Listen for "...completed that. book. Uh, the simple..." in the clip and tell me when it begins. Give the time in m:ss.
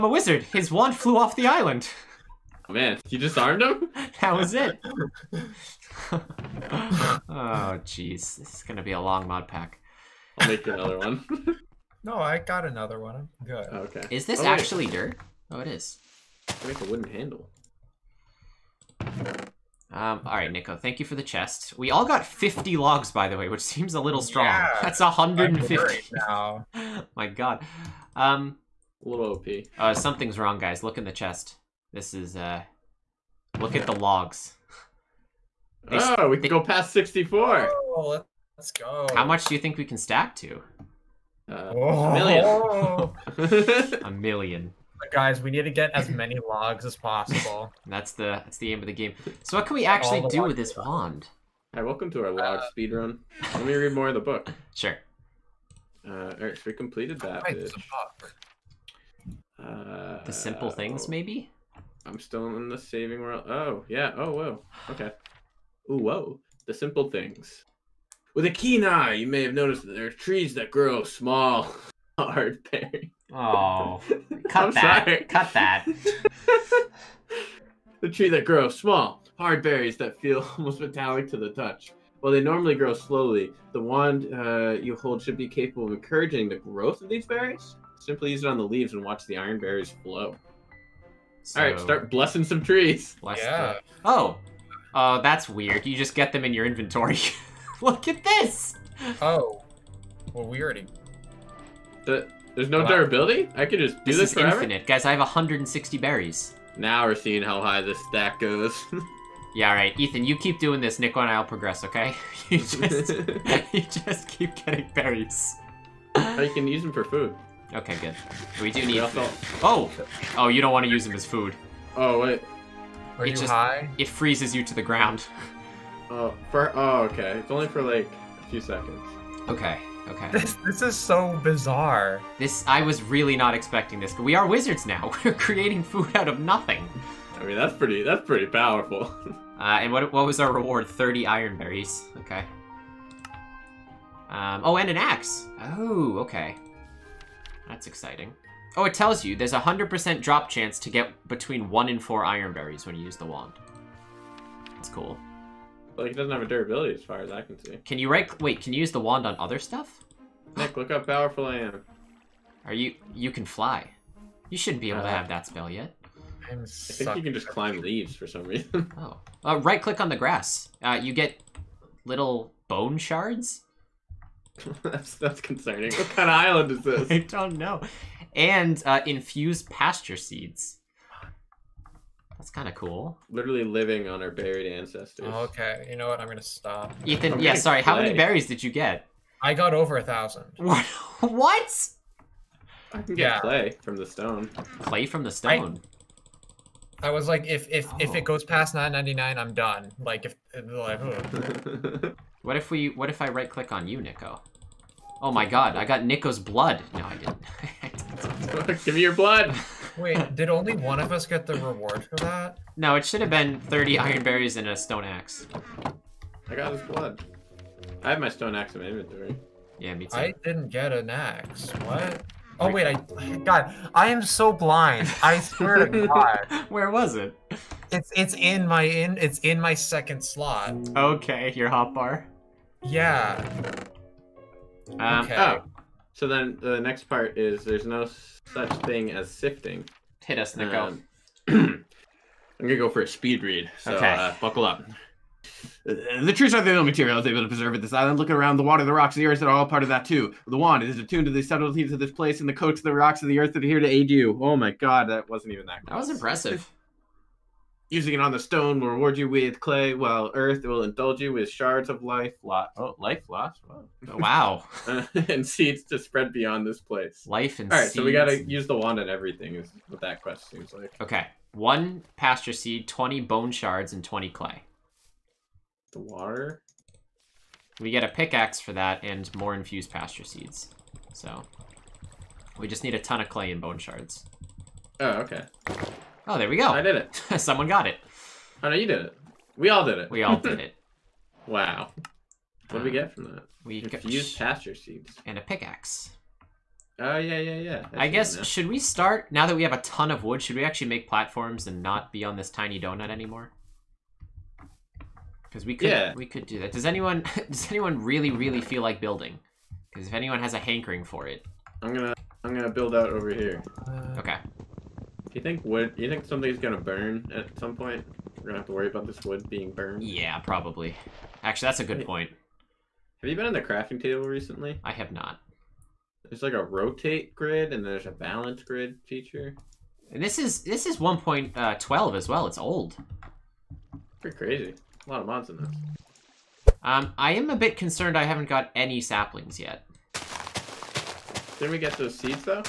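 0:56.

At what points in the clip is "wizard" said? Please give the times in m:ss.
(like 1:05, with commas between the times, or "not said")
0:00, 2:14.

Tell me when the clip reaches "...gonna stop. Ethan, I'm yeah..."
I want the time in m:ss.
3:06.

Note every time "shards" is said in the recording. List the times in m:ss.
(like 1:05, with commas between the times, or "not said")
2:52, 4:21, 4:33, 4:43.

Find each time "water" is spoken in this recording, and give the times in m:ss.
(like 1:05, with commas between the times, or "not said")
4:08, 4:36.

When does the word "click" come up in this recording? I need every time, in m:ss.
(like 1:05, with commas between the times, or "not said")
2:49, 3:23.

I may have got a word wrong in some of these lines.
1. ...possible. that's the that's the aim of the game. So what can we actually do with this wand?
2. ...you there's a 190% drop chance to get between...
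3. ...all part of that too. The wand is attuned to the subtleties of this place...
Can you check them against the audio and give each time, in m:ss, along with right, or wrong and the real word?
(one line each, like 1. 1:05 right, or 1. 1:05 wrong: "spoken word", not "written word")
1. 0:46 right
2. 2:29 wrong: "100", not "190"
3. 4:09 right.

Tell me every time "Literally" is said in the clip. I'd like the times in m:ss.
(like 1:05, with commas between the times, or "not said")
3:03.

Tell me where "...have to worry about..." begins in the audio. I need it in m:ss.
5:18.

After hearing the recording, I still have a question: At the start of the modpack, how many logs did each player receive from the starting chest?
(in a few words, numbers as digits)
50.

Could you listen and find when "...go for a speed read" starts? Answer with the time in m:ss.
4:02.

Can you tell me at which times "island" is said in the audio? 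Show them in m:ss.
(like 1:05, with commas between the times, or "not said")
0:01, 2:56, 4:07.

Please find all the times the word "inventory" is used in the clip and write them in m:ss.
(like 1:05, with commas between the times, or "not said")
1:36, 3:38.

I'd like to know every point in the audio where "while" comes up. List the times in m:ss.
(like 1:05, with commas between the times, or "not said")
1:22, 4:19.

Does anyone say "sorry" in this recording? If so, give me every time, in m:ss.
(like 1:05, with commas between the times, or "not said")
1:15, 3:07.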